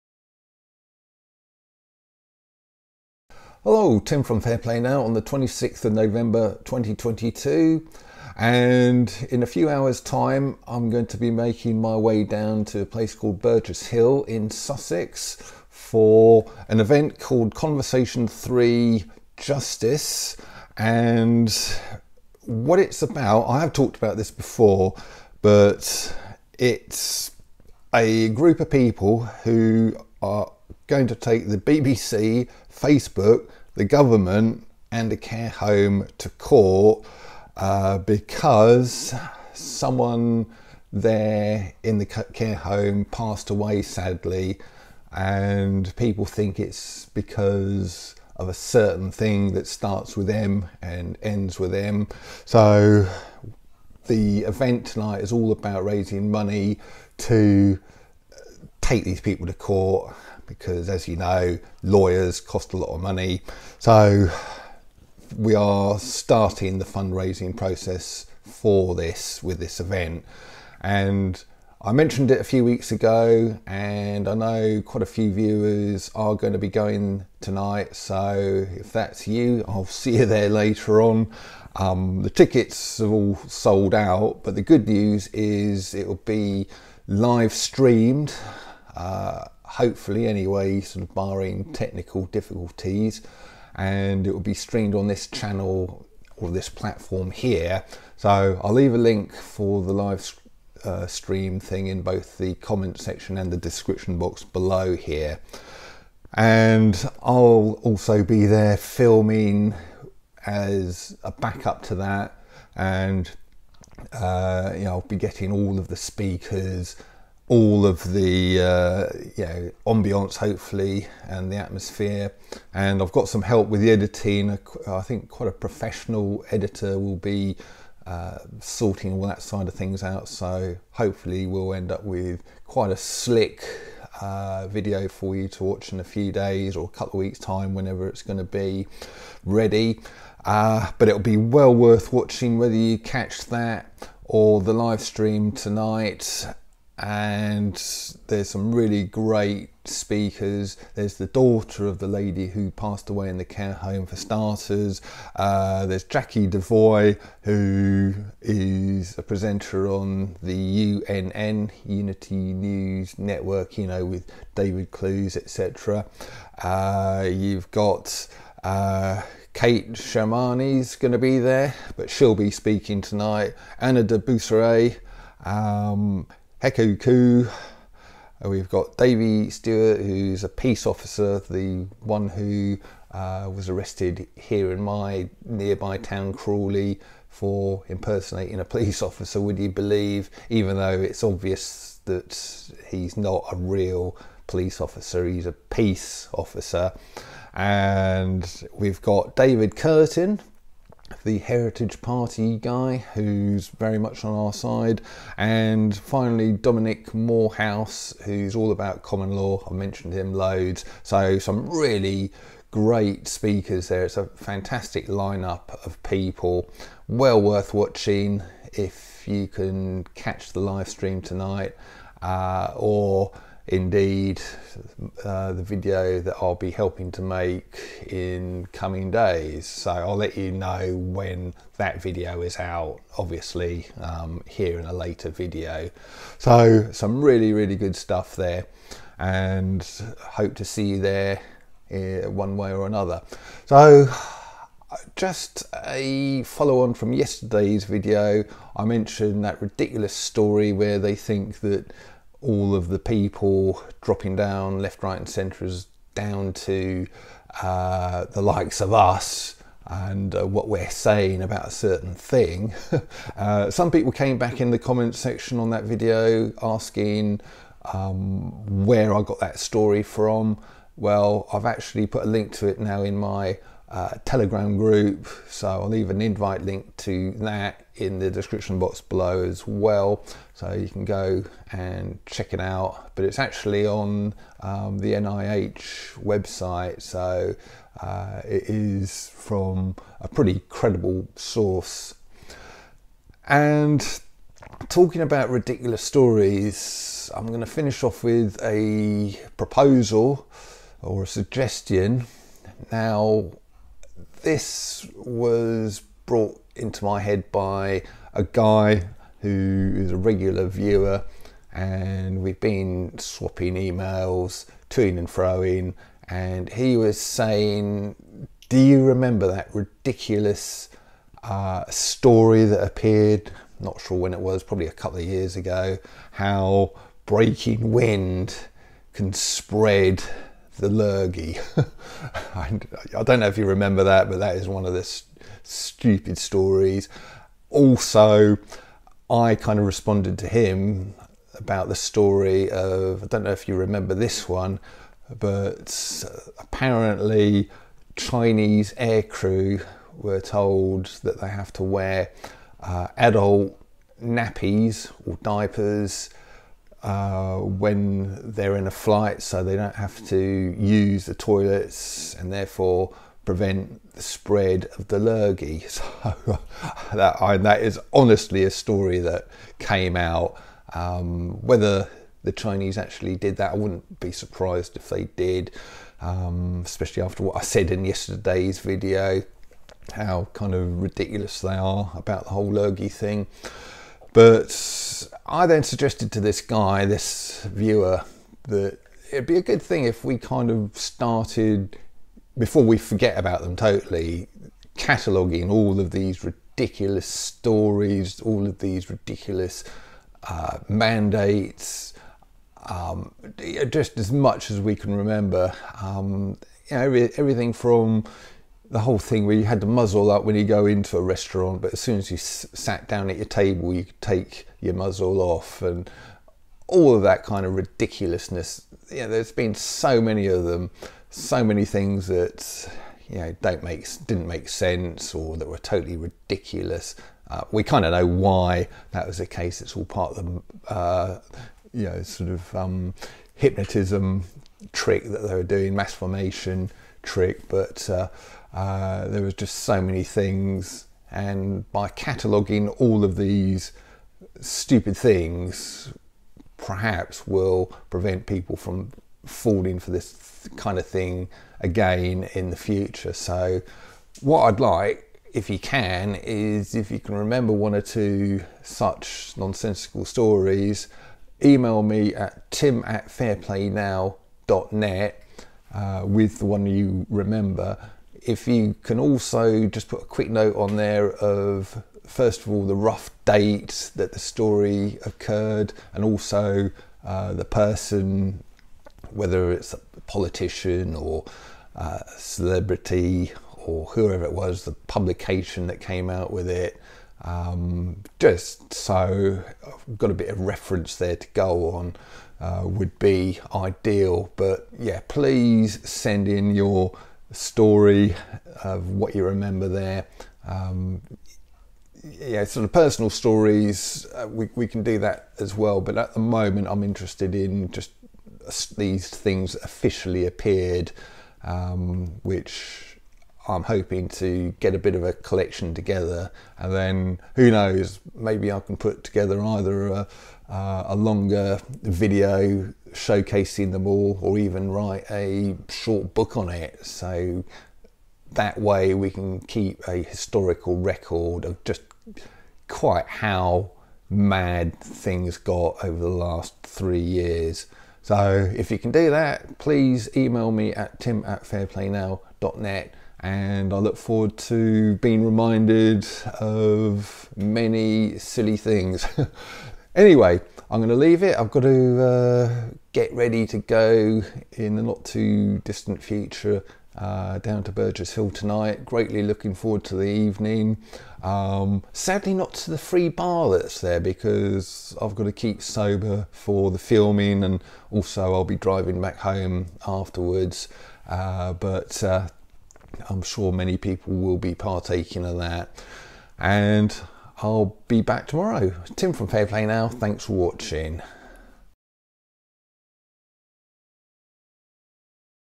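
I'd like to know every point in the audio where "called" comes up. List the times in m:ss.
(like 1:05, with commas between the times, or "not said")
0:13, 0:17.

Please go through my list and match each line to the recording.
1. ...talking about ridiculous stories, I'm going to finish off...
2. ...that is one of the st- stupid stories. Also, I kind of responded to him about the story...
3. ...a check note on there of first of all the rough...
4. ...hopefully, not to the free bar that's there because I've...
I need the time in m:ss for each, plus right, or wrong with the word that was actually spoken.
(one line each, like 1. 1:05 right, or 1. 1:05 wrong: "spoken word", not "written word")
1. 4:54 right
2. 5:34 right
3. 7:50 wrong: "quick", not "check"
4. 9:22 wrong: "sadly", not "hopefully".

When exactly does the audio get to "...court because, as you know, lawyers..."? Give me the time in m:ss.
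0:59.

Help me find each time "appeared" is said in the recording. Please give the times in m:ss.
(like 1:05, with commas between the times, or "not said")
5:22, 8:30.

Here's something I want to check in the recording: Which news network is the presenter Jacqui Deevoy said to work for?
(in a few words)
Unity News Network.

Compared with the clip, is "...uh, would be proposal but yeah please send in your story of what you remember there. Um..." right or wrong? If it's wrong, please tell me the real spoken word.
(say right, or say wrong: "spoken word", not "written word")
wrong: "ideal", not "proposal".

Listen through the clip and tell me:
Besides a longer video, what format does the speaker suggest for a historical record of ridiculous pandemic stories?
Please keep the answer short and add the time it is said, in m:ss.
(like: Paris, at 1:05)
A short book, at 8:45.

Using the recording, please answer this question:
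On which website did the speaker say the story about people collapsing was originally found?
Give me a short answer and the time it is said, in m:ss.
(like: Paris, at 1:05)
NIH website, at 4:45.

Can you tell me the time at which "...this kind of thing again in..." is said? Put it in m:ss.
7:30.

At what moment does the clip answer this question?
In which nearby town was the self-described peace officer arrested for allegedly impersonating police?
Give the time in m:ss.
3:06.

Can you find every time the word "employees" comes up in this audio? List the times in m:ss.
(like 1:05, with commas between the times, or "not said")
not said.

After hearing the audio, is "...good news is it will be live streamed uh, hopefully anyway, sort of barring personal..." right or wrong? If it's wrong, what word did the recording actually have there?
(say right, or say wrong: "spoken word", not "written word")
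wrong: "technical", not "personal".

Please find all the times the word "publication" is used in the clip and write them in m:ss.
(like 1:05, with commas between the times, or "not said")
8:05.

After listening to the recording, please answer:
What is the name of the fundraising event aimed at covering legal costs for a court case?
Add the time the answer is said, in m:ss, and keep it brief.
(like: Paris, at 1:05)
Conversation 3 Justice, at 0:17.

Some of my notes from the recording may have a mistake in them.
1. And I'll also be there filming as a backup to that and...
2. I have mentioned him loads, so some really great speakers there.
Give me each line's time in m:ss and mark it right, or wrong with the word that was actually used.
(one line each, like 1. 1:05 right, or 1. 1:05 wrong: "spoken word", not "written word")
1. 1:46 right
2. 3:29 right.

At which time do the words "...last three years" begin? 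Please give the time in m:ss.
8:56.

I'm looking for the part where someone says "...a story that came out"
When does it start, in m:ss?
6:08.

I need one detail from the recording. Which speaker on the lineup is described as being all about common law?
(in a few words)
Dominic Morehouse.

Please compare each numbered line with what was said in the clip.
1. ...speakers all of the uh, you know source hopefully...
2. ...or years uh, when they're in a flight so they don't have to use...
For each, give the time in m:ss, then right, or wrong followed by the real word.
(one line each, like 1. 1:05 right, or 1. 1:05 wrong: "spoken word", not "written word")
1. 1:55 wrong: "ambiance", not "source"
2. 5:55 wrong: "diapers", not "years".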